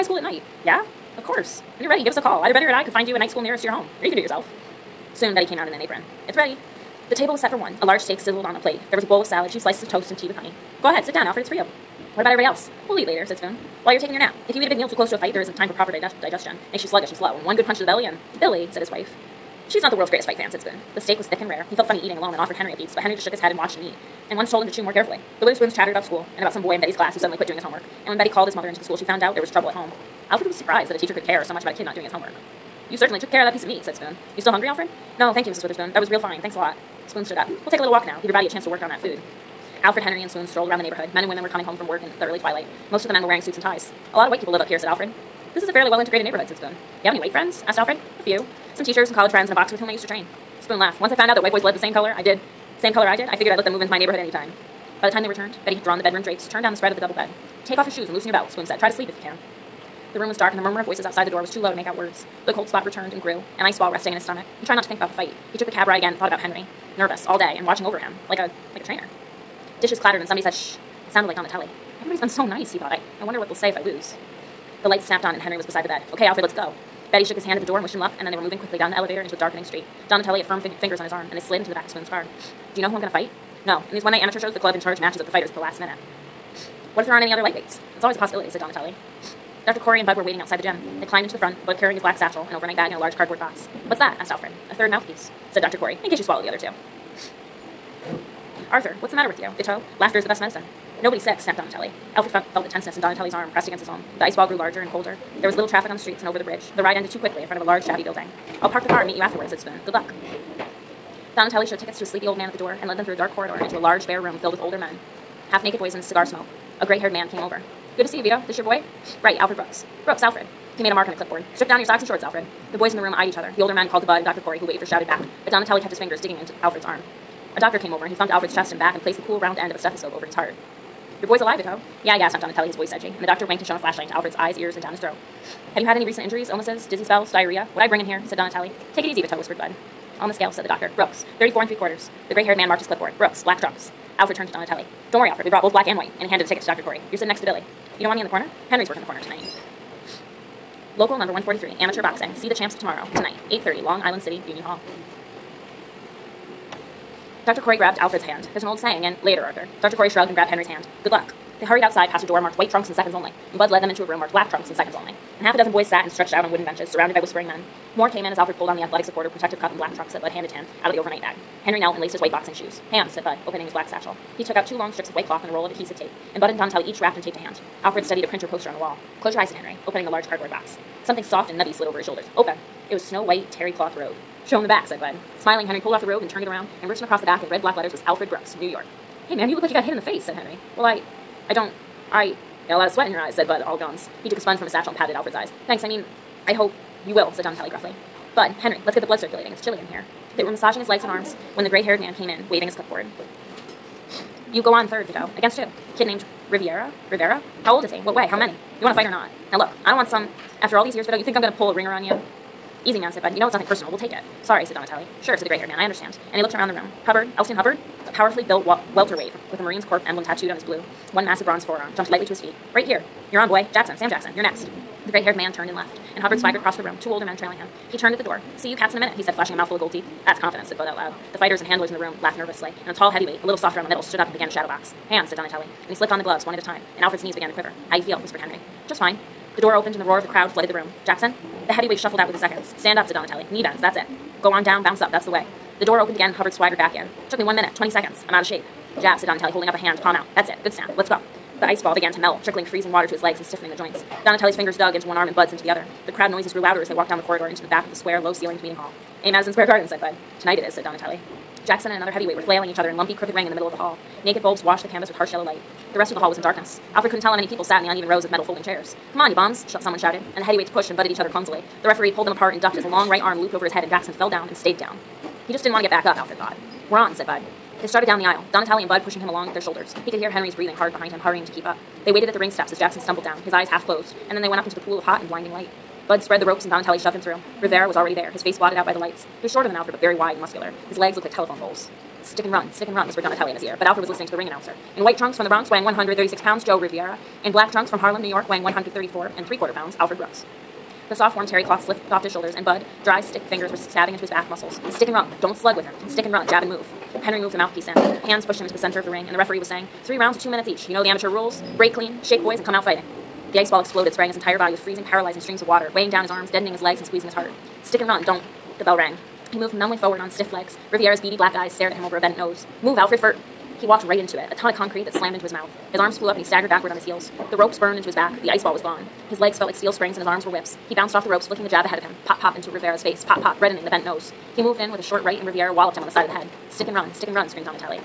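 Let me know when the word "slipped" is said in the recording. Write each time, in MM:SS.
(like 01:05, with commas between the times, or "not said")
03:55, 05:01.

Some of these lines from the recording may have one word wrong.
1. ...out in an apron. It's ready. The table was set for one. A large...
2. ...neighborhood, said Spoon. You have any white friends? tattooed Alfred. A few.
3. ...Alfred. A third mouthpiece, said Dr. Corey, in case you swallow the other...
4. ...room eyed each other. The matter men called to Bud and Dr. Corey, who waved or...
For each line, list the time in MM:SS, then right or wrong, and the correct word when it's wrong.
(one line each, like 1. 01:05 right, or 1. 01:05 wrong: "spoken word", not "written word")
1. 00:05 right
2. 00:46 wrong: "asked", not "tattooed"
3. 01:34 right
4. 02:03 wrong: "older", not "matter".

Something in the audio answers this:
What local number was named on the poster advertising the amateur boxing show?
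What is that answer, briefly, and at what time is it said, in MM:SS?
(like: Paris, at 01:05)
143, at 02:30.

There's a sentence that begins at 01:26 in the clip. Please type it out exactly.
What if there aren't any other lightweights?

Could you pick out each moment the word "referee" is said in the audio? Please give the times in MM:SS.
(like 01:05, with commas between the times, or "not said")
04:31, 05:09.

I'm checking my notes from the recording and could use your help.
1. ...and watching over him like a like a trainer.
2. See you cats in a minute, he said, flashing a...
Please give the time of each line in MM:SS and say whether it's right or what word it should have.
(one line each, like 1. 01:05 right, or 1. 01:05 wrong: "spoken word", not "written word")
1. 01:07 right
2. 03:48 right.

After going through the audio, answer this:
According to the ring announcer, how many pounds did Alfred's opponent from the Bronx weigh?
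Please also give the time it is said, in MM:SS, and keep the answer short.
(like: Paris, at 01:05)
136, at 04:55.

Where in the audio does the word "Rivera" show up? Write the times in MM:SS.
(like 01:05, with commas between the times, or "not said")
03:27, 04:47, 05:32.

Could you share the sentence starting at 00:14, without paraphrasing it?
If you eat a big meal too close to a fight, there isn't time for proper digest- digestion.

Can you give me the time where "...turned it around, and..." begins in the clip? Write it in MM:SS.
03:06.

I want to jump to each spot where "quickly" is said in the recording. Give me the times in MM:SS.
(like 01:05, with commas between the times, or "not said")
01:18, 01:47.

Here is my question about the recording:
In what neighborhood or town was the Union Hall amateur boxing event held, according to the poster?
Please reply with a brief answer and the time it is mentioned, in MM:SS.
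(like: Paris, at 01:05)
Long Island City, at 02:33.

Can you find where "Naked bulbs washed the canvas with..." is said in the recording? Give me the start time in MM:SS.
04:24.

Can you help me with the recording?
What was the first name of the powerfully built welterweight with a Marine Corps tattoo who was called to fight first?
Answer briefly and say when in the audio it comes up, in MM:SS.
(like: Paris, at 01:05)
Elston, at 03:37.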